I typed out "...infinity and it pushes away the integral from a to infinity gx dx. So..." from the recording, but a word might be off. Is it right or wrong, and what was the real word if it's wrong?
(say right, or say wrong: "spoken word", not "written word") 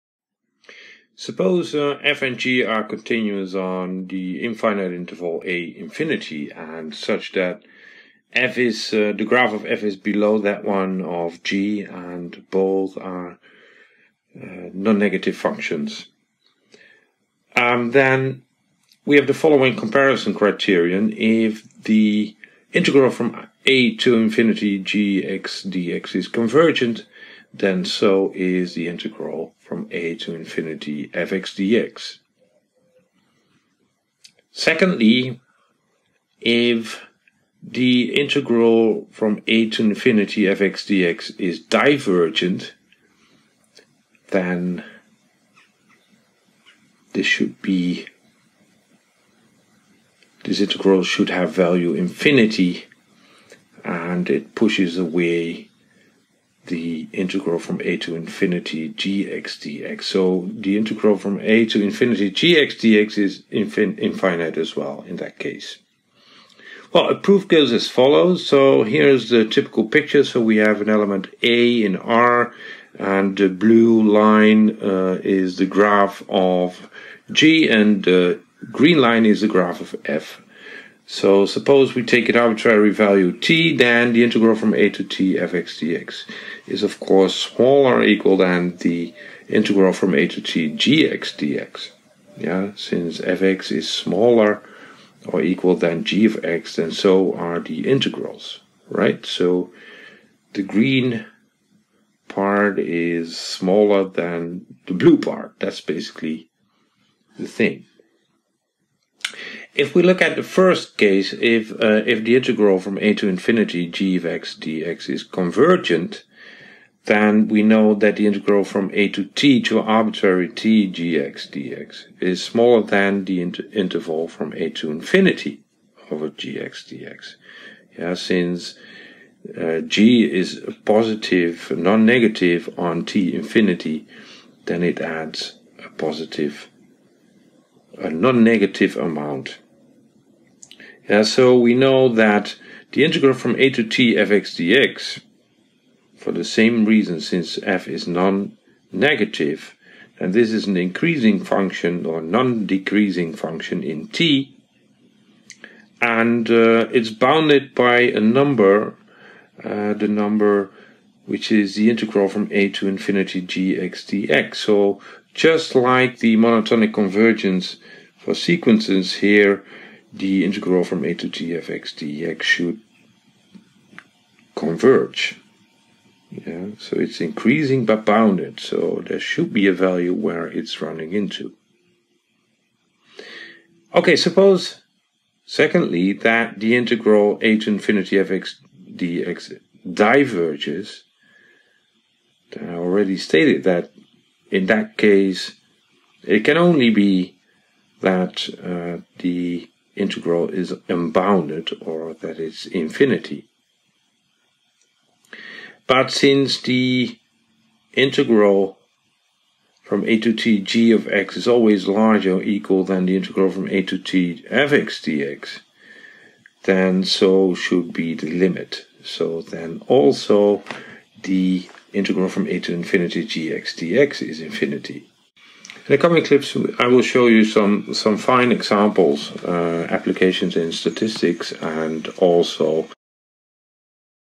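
right.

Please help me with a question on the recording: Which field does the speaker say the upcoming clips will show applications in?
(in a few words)
Statistics.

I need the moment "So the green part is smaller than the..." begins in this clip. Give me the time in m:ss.
1:39.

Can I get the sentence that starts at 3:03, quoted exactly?
Okay, suppose, secondly, that the integral a to infinity of x dx diverges.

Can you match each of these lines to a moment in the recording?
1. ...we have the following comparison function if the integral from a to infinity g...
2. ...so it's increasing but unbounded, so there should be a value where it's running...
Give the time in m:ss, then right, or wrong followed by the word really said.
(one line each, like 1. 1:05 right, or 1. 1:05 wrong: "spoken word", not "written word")
1. 0:19 wrong: "criterion", not "function"
2. 2:56 wrong: "bounded", not "unbounded".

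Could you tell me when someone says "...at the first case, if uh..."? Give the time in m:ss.
1:50.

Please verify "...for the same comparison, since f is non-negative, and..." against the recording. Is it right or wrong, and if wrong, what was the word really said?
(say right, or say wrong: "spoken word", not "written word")
wrong: "reason", not "comparison".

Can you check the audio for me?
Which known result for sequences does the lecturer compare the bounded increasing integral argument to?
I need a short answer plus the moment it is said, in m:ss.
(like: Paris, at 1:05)
Monotonic convergence, at 2:46.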